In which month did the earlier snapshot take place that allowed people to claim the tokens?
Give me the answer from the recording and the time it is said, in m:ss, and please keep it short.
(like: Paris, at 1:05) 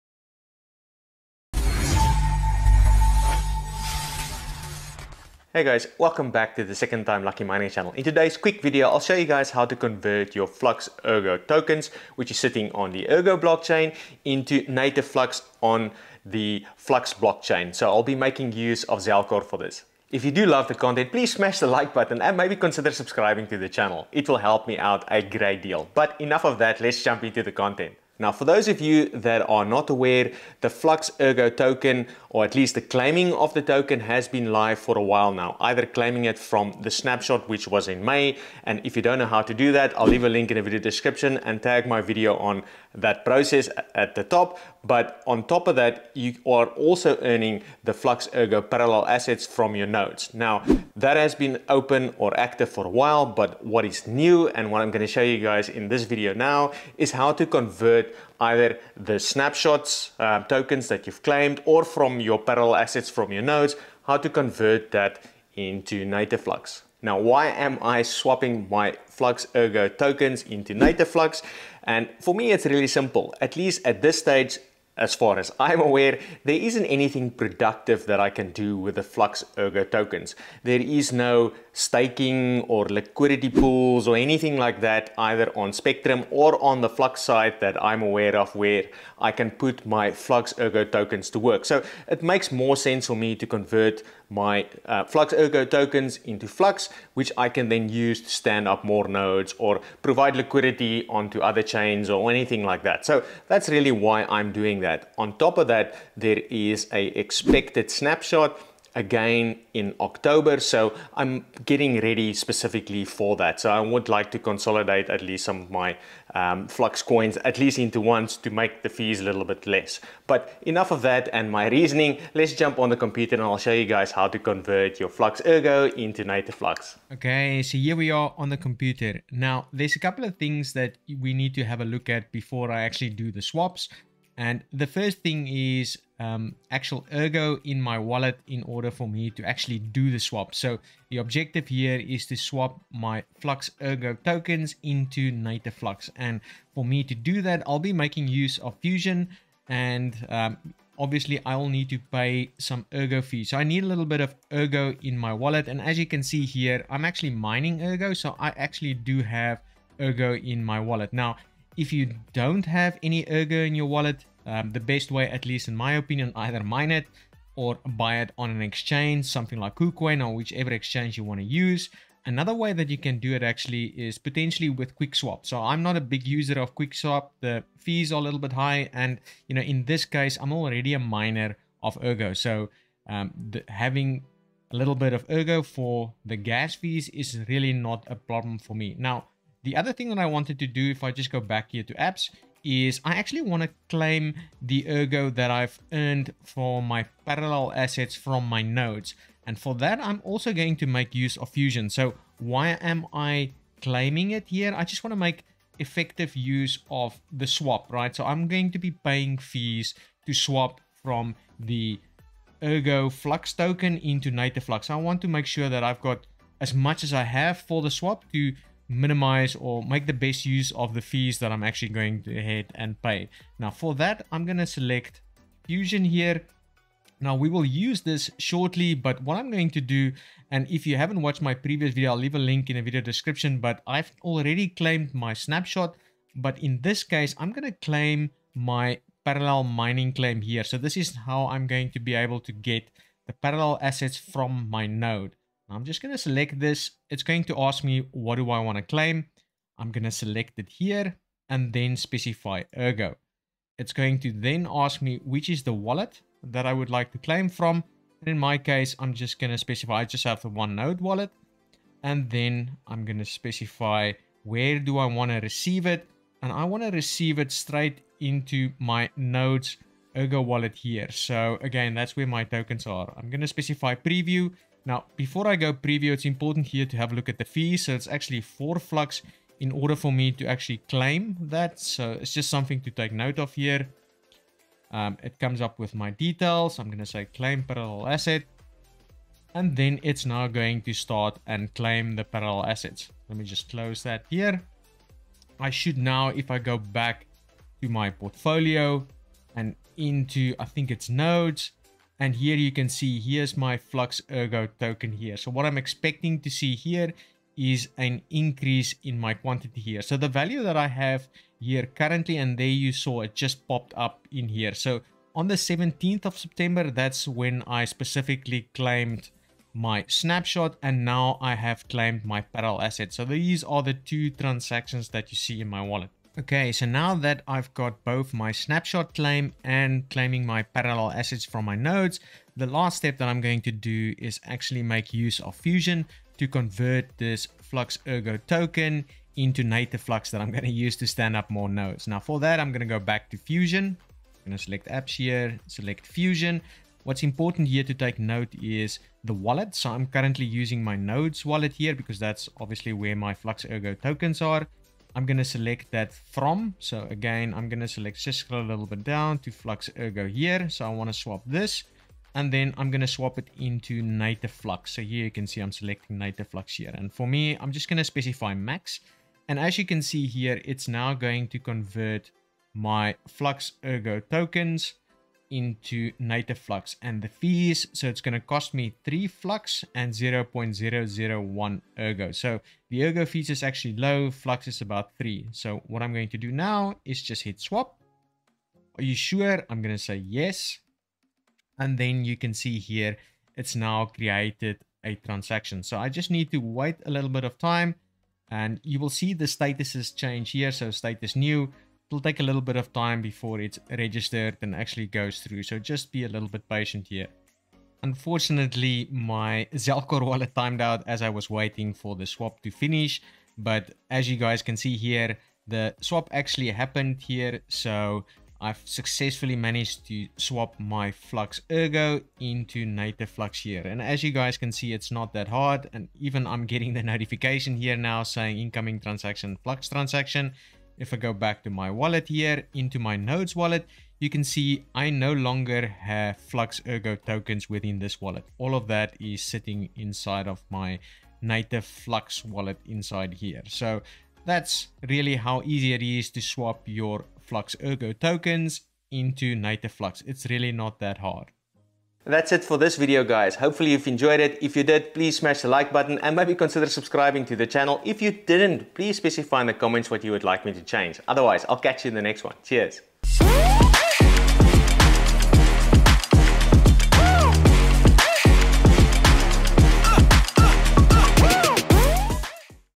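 May, at 0:38.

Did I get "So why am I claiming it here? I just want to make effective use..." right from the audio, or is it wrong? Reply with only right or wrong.
right.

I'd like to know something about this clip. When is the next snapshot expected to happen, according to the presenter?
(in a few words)
October.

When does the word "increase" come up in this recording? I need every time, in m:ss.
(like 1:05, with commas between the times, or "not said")
5:08.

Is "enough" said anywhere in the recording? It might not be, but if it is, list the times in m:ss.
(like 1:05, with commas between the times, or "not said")
0:26, 2:00.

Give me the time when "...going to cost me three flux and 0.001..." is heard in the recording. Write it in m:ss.
6:18.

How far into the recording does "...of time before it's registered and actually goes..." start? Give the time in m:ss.
6:42.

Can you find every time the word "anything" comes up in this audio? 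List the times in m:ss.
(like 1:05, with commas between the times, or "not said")
1:16, 1:24, 1:42.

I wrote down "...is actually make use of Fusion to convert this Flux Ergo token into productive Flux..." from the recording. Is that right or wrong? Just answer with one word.
wrong.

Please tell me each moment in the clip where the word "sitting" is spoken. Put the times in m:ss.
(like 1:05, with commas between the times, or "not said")
0:12, 7:19.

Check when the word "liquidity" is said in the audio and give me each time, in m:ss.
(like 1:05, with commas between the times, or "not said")
1:22, 1:40.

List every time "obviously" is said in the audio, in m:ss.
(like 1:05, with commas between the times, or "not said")
2:30, 5:52.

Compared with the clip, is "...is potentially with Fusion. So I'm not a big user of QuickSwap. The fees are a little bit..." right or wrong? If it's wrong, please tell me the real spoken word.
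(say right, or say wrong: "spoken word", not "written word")
wrong: "QuickSwap", not "Fusion".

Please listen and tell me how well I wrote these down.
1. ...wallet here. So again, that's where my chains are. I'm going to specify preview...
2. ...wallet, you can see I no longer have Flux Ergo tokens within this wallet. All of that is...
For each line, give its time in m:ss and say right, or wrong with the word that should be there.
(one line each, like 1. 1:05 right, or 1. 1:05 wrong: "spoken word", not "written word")
1. 4:30 wrong: "tokens", not "chains"
2. 7:13 right.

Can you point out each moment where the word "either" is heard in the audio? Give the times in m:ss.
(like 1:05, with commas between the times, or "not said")
0:35, 0:58, 1:25, 2:46.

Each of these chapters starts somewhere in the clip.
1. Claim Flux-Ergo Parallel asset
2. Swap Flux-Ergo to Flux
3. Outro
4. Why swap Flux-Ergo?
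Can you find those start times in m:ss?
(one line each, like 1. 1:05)
1. 2:08
2. 5:26
3. 7:36
4. 0:30.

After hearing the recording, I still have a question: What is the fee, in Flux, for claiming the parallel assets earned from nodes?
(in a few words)
4 flux.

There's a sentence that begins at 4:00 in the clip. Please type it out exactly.
So this is how I'm going to be able to get the parallel assets from my node.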